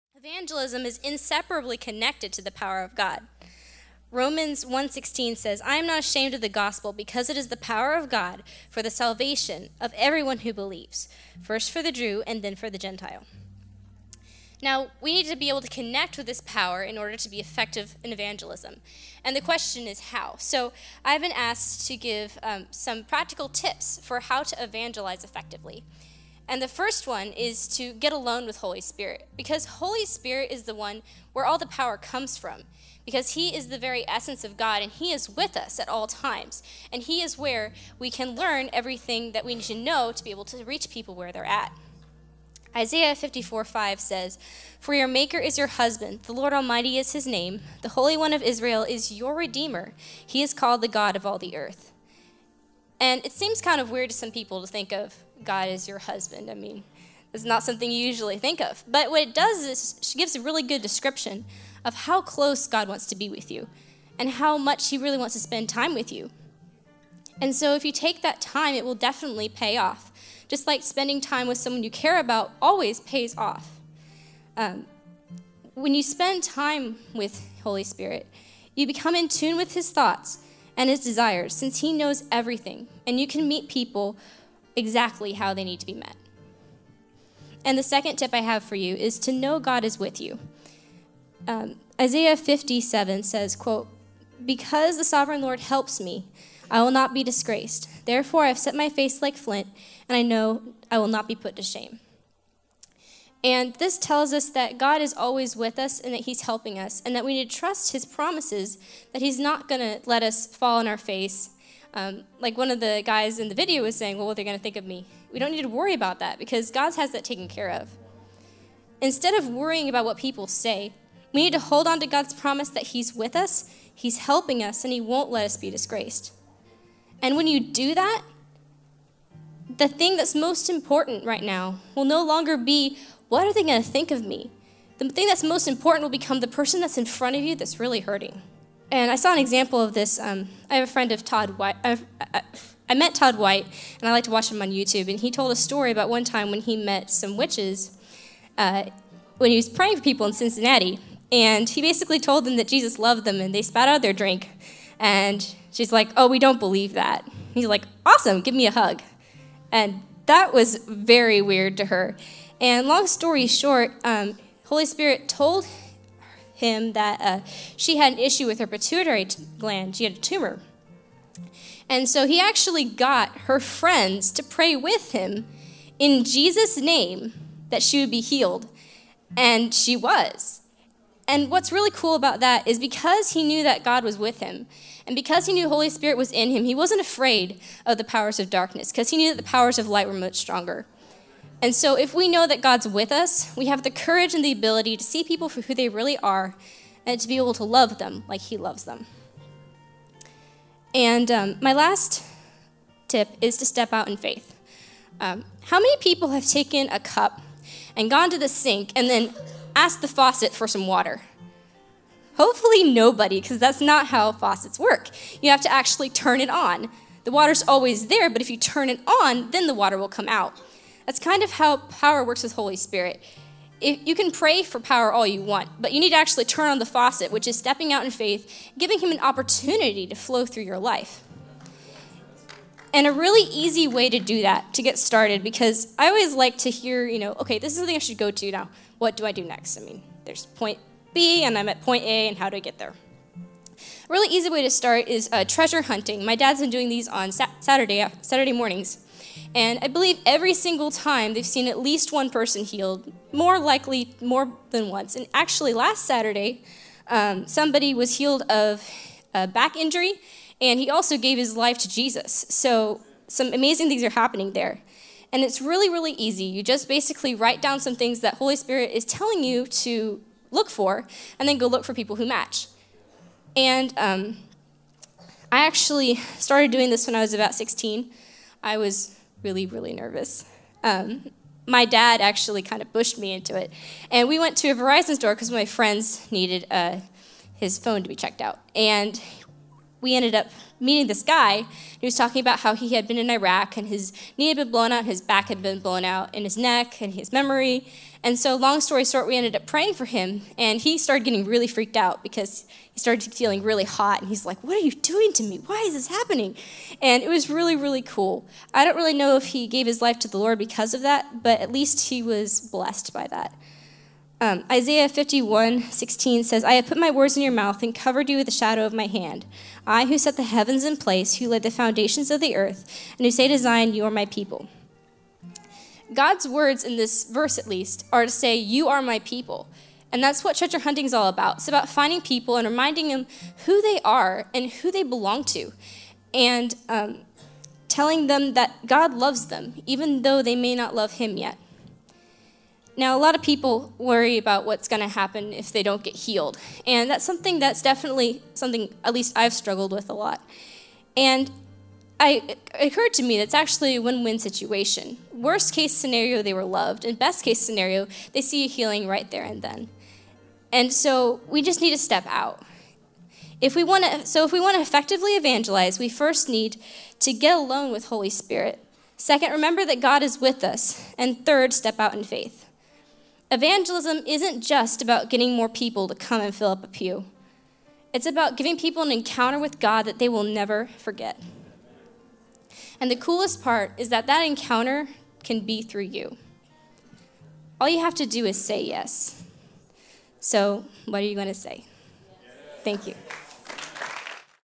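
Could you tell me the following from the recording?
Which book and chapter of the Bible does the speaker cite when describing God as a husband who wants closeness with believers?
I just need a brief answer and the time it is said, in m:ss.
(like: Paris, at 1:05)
Isaiah 54, at 0:42.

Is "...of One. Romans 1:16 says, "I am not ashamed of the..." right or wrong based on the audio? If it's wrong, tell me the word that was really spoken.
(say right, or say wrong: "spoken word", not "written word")
wrong: "God", not "One".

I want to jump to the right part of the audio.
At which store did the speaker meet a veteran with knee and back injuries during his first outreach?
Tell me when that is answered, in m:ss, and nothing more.
4:44.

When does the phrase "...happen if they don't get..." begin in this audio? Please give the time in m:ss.
5:45.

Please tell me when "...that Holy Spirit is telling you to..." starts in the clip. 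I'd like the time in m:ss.
4:28.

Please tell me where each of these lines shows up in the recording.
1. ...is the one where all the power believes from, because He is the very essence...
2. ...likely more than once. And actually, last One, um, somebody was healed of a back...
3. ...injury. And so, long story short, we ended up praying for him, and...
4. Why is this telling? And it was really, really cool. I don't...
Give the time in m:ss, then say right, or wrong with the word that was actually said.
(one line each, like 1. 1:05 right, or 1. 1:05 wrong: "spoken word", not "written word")
1. 0:30 wrong: "comes", not "believes"
2. 4:13 wrong: "Saturday", not "One"
3. 4:57 wrong: "memory", not "injury"
4. 5:05 wrong: "happening", not "telling".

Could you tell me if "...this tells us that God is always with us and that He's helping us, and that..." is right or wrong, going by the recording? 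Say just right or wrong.
right.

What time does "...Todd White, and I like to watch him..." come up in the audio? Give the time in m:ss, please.
2:23.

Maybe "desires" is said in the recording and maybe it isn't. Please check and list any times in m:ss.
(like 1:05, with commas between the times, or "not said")
1:21.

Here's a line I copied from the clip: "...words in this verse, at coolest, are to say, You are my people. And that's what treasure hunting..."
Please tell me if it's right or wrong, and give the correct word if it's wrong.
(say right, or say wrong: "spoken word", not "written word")
wrong: "least", not "coolest".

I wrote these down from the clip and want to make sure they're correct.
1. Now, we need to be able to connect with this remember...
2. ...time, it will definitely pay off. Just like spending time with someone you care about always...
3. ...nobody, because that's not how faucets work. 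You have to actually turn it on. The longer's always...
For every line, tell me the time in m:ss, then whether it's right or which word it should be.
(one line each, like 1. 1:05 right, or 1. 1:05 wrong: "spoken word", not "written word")
1. 0:14 wrong: "power", not "remember"
2. 1:08 right
3. 3:32 wrong: "water", not "longer".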